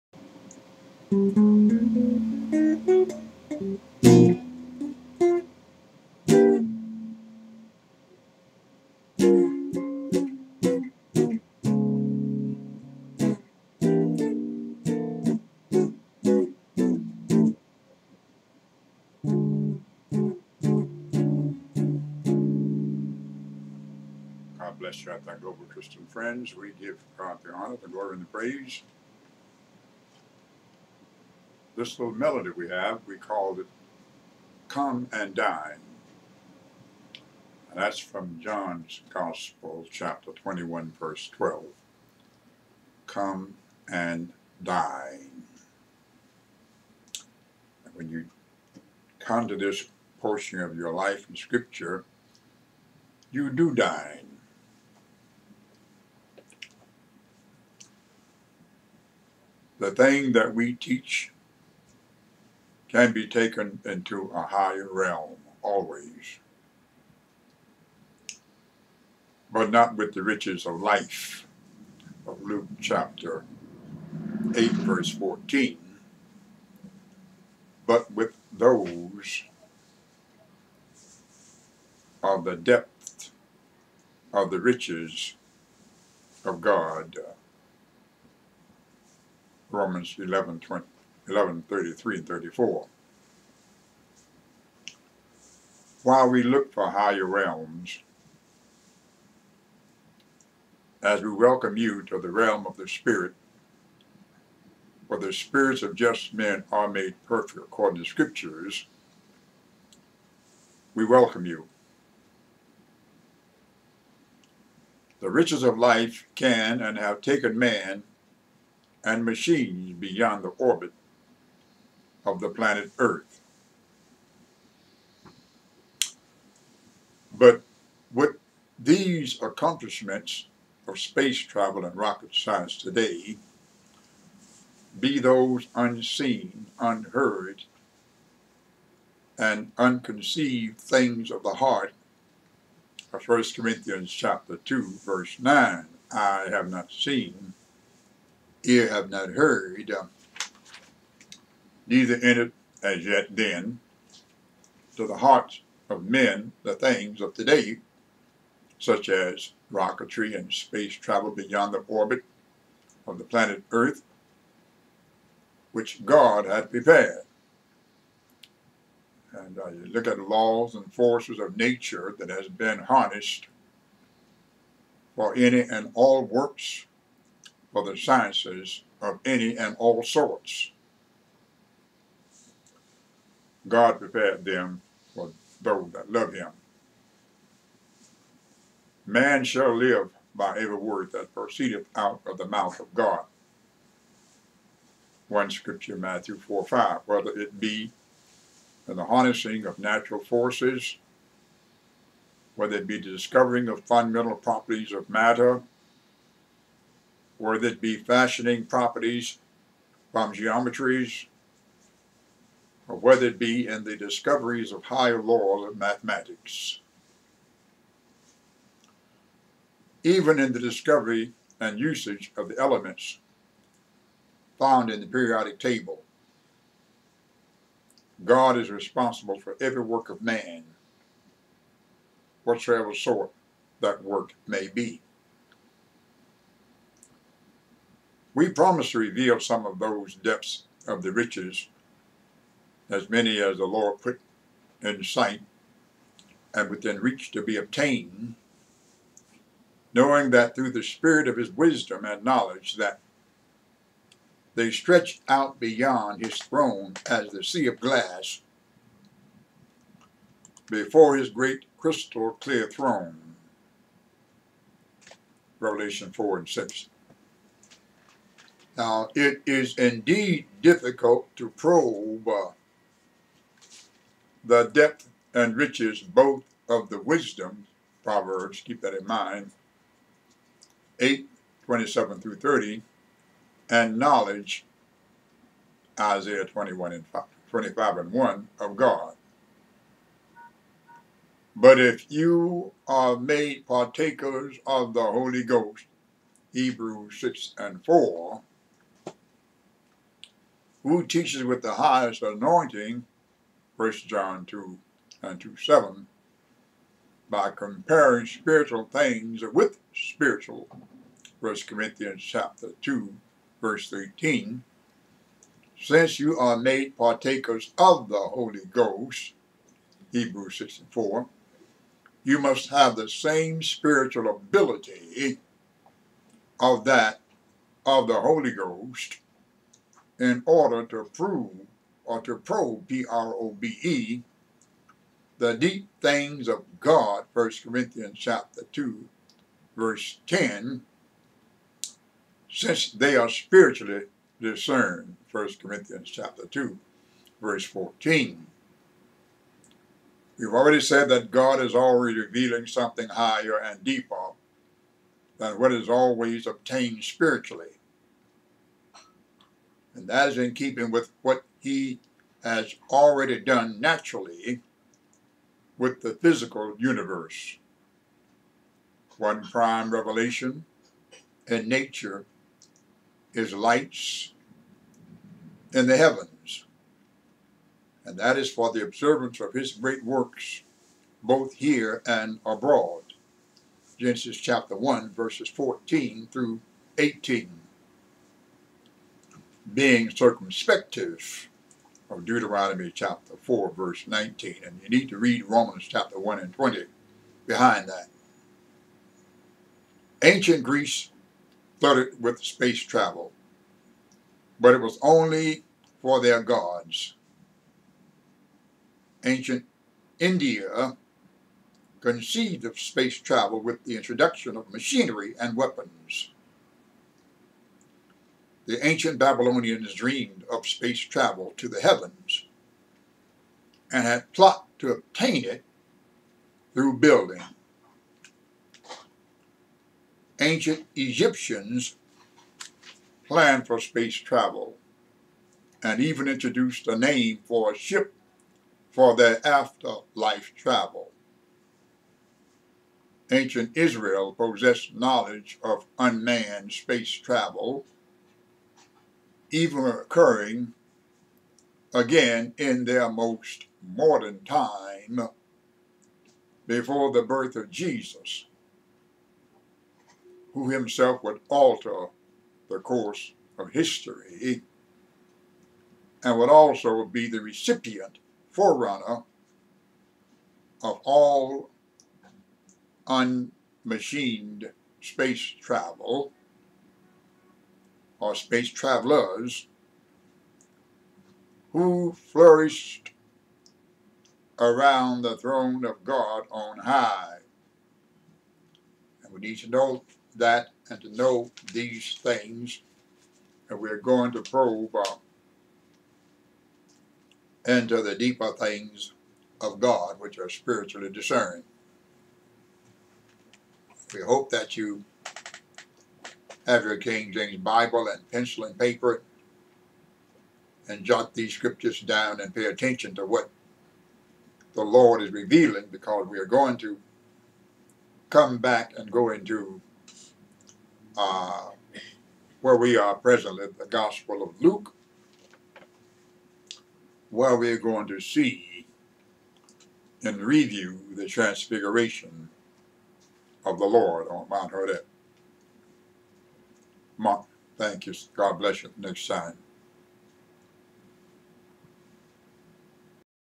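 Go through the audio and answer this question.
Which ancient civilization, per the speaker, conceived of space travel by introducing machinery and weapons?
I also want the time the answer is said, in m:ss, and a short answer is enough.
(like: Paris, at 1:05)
Ancient India, at 6:49.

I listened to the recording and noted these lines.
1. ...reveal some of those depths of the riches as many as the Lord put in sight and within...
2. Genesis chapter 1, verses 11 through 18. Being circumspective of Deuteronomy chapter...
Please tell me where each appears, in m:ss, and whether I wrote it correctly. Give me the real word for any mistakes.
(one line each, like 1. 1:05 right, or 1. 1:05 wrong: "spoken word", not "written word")
1. 3:58 right
2. 6:23 wrong: "14", not "11".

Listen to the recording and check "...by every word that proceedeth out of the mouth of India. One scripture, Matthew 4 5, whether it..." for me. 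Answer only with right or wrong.
wrong.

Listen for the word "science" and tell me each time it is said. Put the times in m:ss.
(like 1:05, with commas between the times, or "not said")
2:12, 2:57.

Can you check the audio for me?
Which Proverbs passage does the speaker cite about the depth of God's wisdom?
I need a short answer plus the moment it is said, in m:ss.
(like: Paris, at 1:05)
Proverbs 8:27-30, at 4:40.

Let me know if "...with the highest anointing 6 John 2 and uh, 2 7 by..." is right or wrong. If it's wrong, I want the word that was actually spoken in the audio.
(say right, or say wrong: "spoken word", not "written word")
wrong: "1", not "6".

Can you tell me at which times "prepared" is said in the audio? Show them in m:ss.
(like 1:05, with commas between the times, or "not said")
2:46, 3:03.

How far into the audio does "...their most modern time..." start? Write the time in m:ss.
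7:32.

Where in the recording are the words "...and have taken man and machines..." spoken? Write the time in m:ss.
1:56.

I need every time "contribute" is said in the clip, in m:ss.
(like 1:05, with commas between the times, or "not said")
not said.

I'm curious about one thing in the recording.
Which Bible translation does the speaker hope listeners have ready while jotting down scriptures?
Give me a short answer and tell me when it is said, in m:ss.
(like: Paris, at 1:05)
King James Bible, at 8:26.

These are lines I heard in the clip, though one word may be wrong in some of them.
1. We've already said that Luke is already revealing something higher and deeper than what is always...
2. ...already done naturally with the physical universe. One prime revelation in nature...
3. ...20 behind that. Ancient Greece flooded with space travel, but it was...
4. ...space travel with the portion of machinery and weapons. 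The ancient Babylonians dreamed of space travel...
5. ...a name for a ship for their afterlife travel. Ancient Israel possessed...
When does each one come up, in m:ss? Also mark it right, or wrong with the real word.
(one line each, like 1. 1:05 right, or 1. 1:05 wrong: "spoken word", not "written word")
1. 5:50 wrong: "God", not "Luke"
2. 6:02 right
3. 6:36 right
4. 6:52 wrong: "introduction", not "portion"
5. 7:16 right.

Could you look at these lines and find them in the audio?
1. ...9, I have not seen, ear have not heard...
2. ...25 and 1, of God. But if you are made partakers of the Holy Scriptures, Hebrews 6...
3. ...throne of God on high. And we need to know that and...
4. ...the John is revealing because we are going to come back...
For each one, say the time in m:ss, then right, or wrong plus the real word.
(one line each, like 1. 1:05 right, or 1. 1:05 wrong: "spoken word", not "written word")
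1. 2:25 right
2. 4:47 wrong: "Ghost", not "Scriptures"
3. 8:05 right
4. 8:34 wrong: "Lord", not "John".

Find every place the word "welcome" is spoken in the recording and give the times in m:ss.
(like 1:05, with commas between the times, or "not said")
1:41, 1:51.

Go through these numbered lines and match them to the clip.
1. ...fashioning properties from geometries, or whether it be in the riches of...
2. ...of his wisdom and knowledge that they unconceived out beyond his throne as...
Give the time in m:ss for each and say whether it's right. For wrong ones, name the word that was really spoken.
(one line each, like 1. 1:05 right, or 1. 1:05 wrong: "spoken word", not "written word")
1. 3:27 wrong: "discoveries", not "riches"
2. 4:11 wrong: "stretched", not "unconceived".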